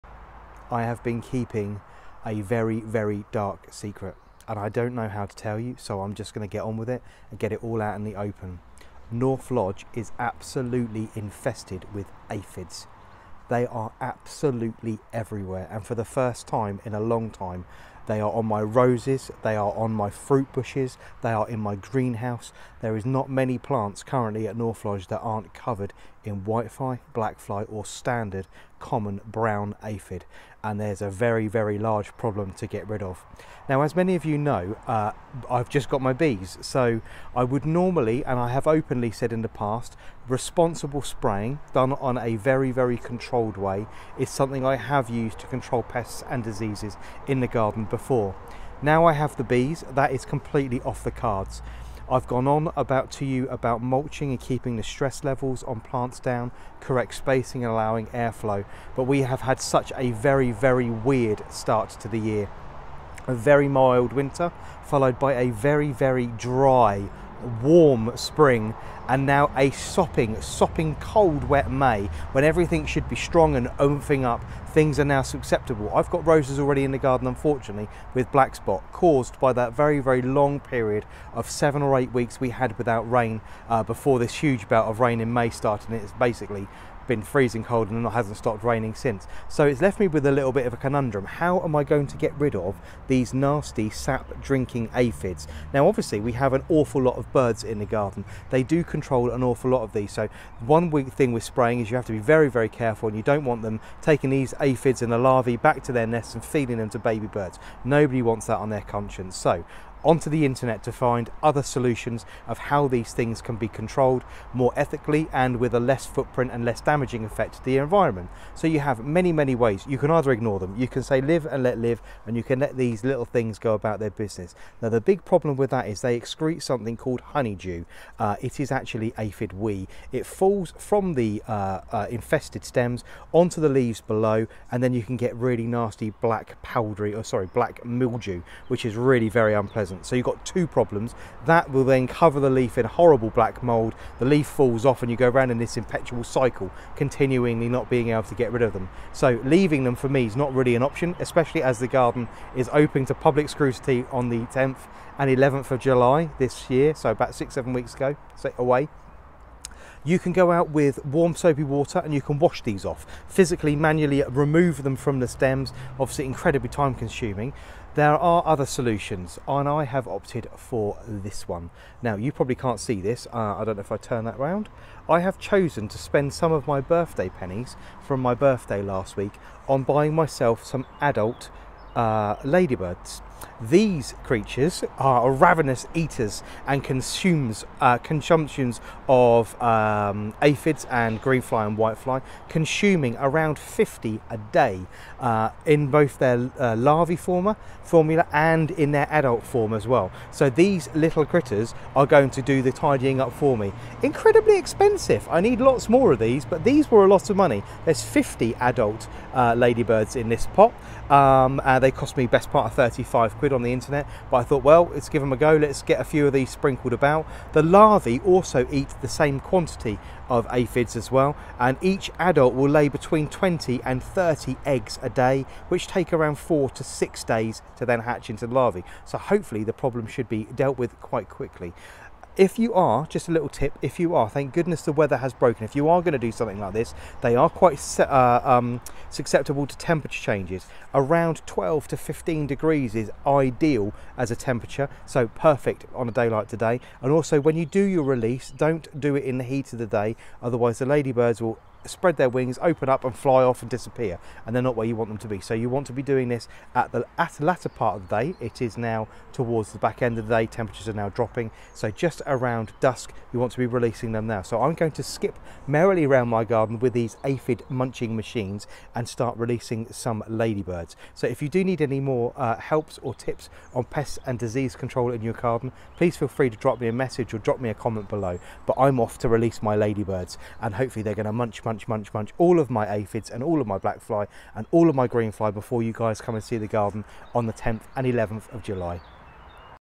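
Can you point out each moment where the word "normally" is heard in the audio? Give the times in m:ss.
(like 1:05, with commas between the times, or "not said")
0:37.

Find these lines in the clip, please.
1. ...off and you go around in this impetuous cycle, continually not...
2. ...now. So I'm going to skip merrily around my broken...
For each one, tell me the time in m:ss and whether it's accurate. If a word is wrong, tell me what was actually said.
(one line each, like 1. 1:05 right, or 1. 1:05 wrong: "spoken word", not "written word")
1. 2:24 right
2. 4:24 wrong: "garden", not "broken".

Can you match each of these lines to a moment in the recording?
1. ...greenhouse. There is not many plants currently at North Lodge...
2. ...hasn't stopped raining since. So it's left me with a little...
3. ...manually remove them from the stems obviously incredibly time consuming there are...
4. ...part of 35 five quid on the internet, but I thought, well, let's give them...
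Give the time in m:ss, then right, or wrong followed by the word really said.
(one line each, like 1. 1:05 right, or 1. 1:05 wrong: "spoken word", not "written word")
1. 0:21 right
2. 1:28 right
3. 2:43 right
4. 3:32 right.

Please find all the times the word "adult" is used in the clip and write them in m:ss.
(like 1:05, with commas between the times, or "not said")
3:01, 3:19, 3:28, 3:42.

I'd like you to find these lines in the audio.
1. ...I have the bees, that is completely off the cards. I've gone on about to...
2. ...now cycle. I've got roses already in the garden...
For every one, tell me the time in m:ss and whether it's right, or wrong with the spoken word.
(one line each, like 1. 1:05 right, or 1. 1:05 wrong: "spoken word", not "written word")
1. 0:49 right
2. 1:15 wrong: "susceptible", not "cycle".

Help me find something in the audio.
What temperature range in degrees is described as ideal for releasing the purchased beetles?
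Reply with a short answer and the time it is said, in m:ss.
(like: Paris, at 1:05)
12 to 15, at 4:01.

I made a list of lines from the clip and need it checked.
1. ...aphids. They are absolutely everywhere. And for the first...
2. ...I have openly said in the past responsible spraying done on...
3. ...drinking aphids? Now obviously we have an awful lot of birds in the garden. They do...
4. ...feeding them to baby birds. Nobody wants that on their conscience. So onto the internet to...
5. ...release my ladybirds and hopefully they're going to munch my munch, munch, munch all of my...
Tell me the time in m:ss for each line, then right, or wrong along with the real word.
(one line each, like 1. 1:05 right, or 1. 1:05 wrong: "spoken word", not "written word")
1. 0:12 right
2. 0:38 right
3. 1:34 right
4. 1:46 right
5. 4:39 right.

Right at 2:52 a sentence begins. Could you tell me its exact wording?
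Now you probably can't see this, uh, I don't know if I turn that round.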